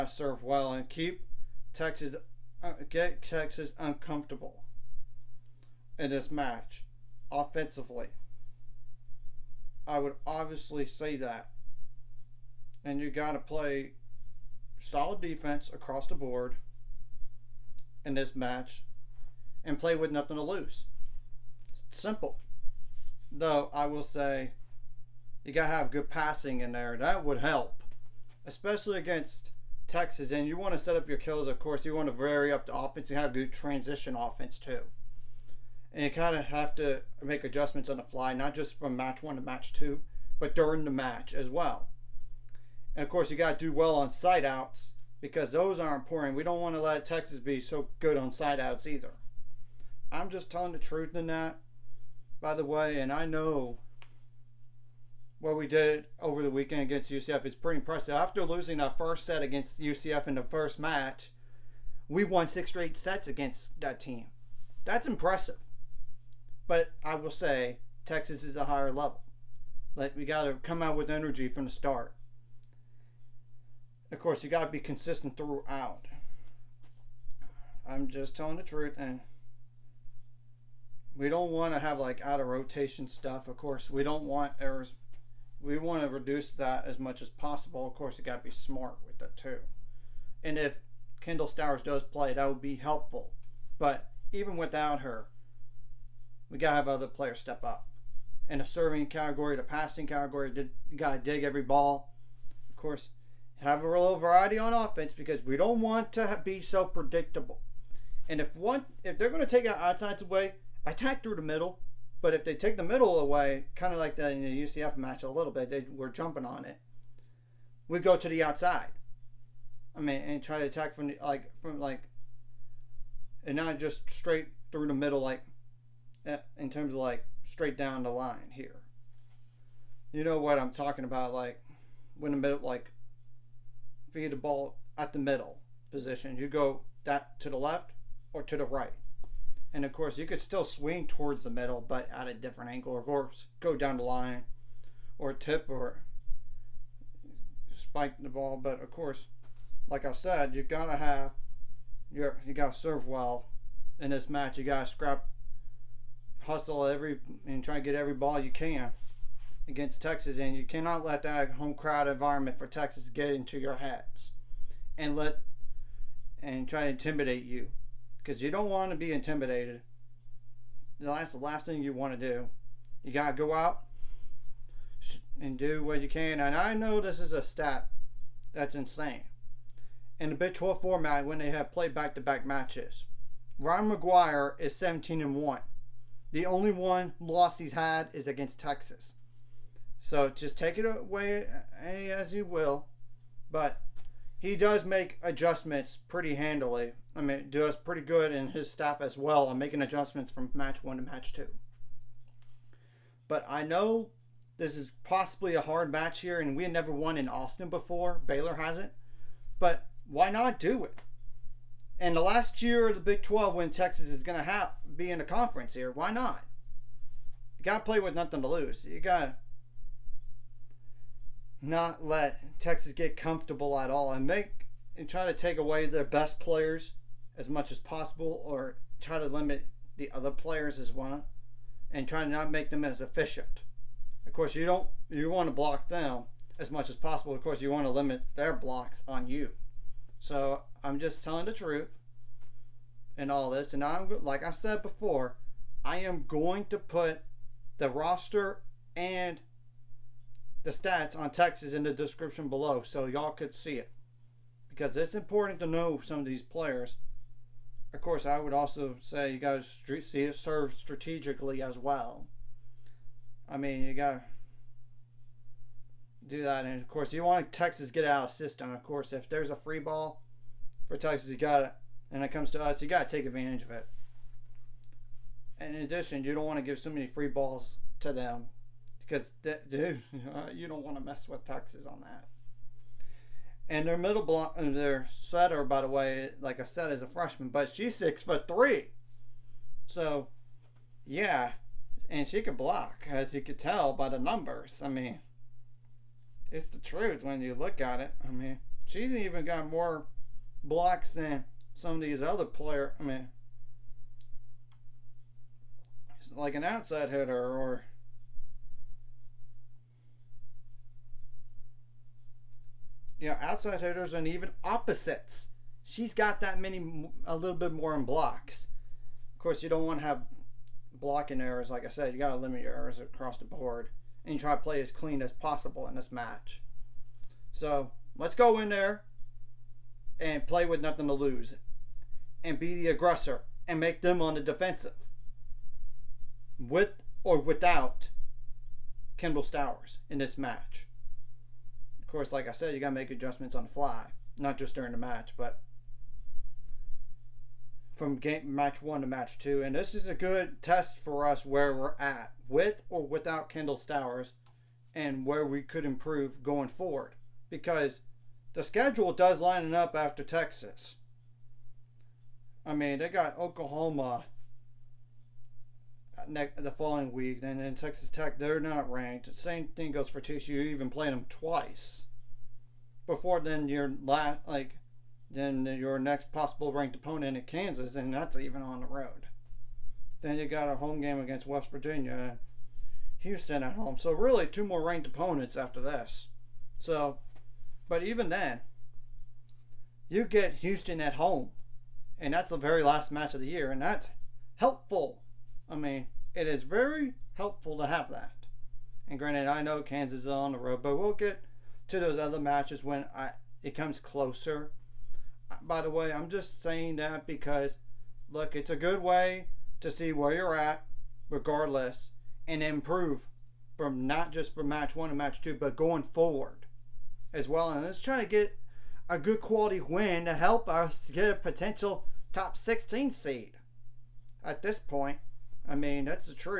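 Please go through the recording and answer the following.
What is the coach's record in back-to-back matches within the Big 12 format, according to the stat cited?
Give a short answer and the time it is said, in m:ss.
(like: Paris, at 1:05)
17 and 1, at 3:04.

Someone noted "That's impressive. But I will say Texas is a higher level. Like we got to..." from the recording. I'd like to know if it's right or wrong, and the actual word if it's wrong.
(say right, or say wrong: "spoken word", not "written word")
right.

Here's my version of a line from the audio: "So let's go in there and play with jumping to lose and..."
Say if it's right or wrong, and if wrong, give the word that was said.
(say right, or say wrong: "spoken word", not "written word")
wrong: "nothing", not "jumping".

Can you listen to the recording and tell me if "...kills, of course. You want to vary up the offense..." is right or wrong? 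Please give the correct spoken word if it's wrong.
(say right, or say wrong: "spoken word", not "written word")
right.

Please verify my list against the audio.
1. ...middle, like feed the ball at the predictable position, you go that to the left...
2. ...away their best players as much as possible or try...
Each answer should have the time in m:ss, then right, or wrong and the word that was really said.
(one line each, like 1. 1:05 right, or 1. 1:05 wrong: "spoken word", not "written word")
1. 2:12 wrong: "middle", not "predictable"
2. 3:45 right.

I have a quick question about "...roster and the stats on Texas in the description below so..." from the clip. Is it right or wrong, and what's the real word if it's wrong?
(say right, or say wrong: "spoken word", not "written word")
right.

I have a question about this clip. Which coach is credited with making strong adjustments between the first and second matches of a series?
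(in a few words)
Ryan McGuire.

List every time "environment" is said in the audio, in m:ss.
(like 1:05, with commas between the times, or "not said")
2:42.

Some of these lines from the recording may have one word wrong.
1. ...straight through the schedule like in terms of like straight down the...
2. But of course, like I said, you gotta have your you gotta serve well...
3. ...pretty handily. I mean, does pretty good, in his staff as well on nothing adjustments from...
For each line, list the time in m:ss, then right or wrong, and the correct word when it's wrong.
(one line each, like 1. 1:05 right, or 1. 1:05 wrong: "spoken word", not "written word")
1. 2:04 wrong: "middle", not "schedule"
2. 2:28 right
3. 3:16 wrong: "making", not "nothing".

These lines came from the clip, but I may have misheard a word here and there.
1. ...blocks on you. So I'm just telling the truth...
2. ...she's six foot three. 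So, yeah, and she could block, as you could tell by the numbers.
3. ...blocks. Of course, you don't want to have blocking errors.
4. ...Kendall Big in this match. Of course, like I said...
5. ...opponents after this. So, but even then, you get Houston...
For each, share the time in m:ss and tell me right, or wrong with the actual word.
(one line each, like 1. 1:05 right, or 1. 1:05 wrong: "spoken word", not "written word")
1. 3:58 right
2. 4:47 right
3. 5:18 right
4. 5:39 wrong: "Stowers", not "Big"
5. 6:25 right.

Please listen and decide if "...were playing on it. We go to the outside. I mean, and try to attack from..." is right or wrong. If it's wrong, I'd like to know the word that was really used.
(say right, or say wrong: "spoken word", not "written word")
wrong: "jumping", not "playing".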